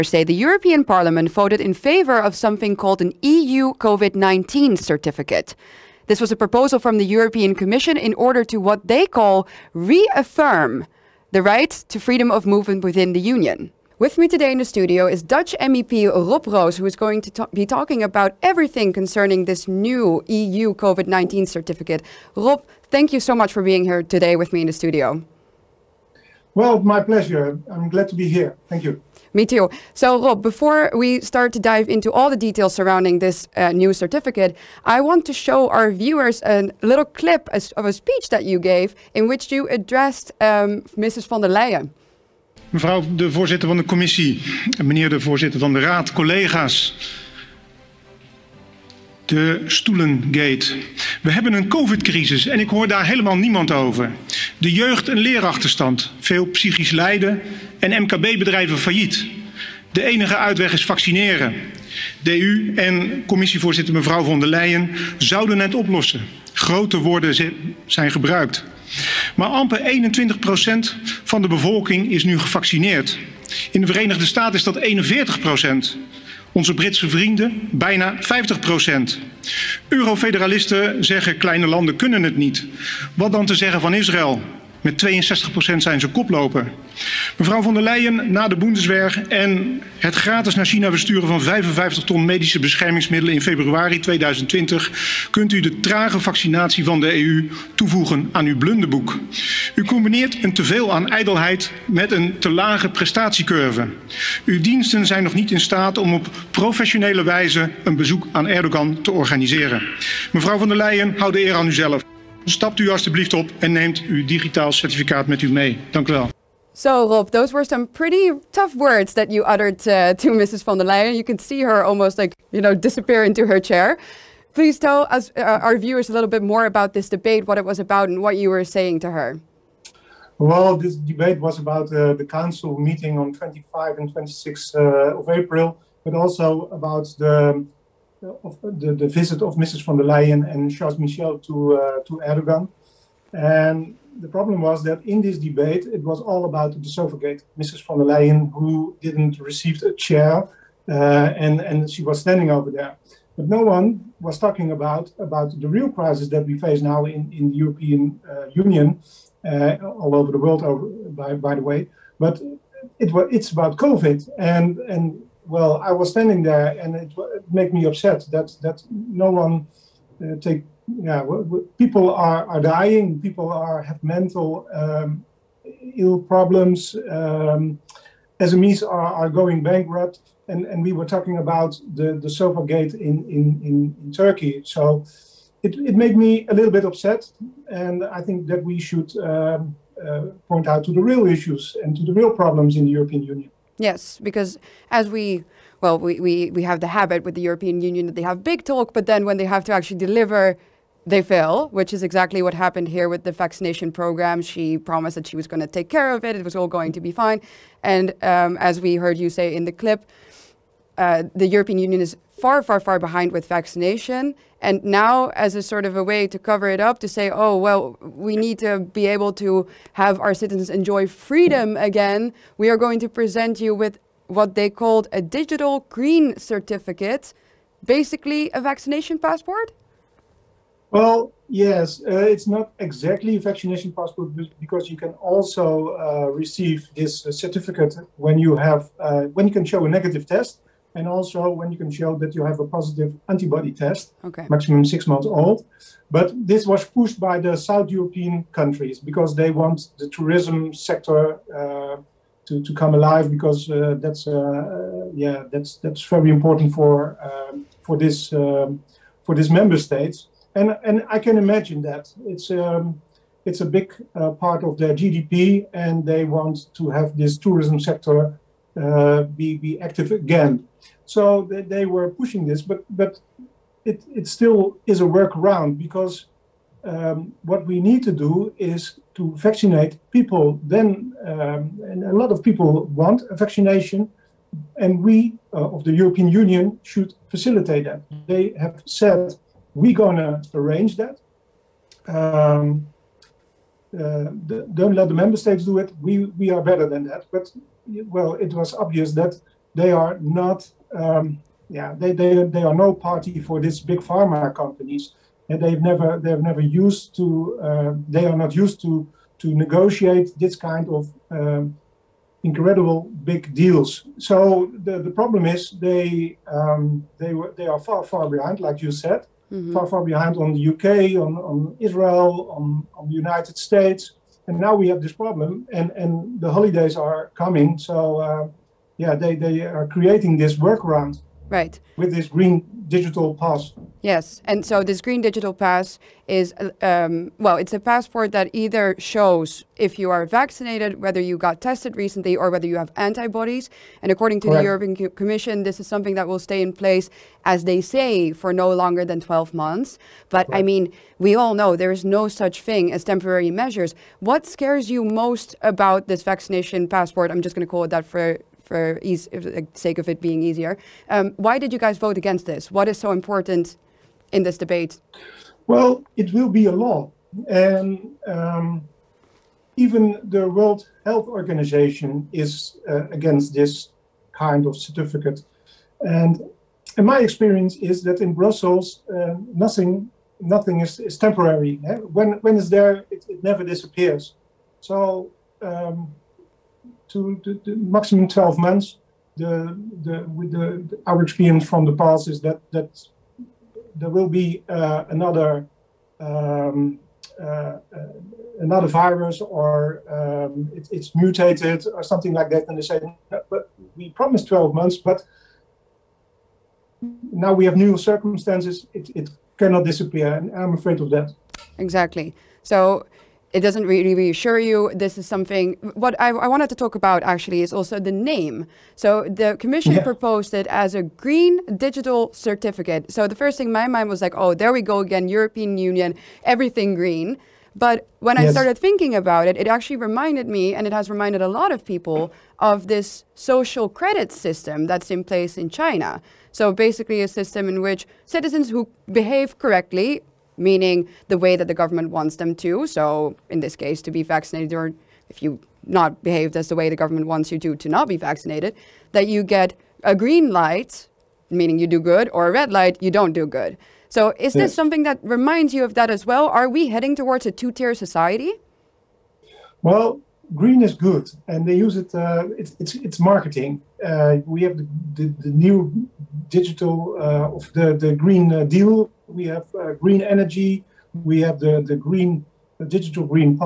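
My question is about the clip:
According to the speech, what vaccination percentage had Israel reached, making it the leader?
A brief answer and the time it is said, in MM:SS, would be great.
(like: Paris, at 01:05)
62%, at 01:25.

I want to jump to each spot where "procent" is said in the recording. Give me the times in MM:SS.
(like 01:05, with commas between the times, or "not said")
01:10, 01:18.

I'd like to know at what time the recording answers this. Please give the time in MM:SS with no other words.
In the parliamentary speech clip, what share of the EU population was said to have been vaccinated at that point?
01:10.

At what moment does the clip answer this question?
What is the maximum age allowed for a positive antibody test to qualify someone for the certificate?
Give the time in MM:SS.
04:04.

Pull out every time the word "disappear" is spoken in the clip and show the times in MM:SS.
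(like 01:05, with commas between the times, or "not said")
02:02, 06:23, 06:49.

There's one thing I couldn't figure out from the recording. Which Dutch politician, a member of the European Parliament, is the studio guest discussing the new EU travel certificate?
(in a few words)
Rob Roos.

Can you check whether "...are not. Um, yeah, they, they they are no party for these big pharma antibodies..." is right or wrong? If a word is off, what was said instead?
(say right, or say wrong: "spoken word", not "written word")
wrong: "companies", not "antibodies".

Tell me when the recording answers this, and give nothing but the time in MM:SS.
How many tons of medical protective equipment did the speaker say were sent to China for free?
01:31.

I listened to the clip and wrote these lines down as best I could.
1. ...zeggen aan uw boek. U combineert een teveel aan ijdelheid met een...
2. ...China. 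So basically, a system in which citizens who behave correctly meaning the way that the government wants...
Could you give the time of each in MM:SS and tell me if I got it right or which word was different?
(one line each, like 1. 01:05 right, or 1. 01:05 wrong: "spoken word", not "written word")
1. 01:37 wrong: "toevoegen", not "zeggen"
2. 07:15 right.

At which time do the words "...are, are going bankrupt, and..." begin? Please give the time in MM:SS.
02:58.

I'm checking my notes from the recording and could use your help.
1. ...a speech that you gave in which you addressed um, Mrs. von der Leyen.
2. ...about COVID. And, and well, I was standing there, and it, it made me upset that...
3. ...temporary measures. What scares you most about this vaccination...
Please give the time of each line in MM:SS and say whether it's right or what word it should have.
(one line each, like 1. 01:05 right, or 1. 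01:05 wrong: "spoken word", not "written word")
1. 00:37 right
2. 02:43 right
3. 05:53 right.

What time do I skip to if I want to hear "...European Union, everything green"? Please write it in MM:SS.
07:05.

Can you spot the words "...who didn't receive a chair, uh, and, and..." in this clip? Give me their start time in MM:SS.
02:28.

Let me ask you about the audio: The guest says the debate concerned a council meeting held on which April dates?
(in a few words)
25 and 26 April.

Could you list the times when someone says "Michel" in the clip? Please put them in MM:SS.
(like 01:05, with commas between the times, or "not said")
02:20.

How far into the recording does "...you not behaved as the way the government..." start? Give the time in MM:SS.
07:25.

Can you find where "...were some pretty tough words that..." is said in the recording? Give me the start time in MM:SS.
01:57.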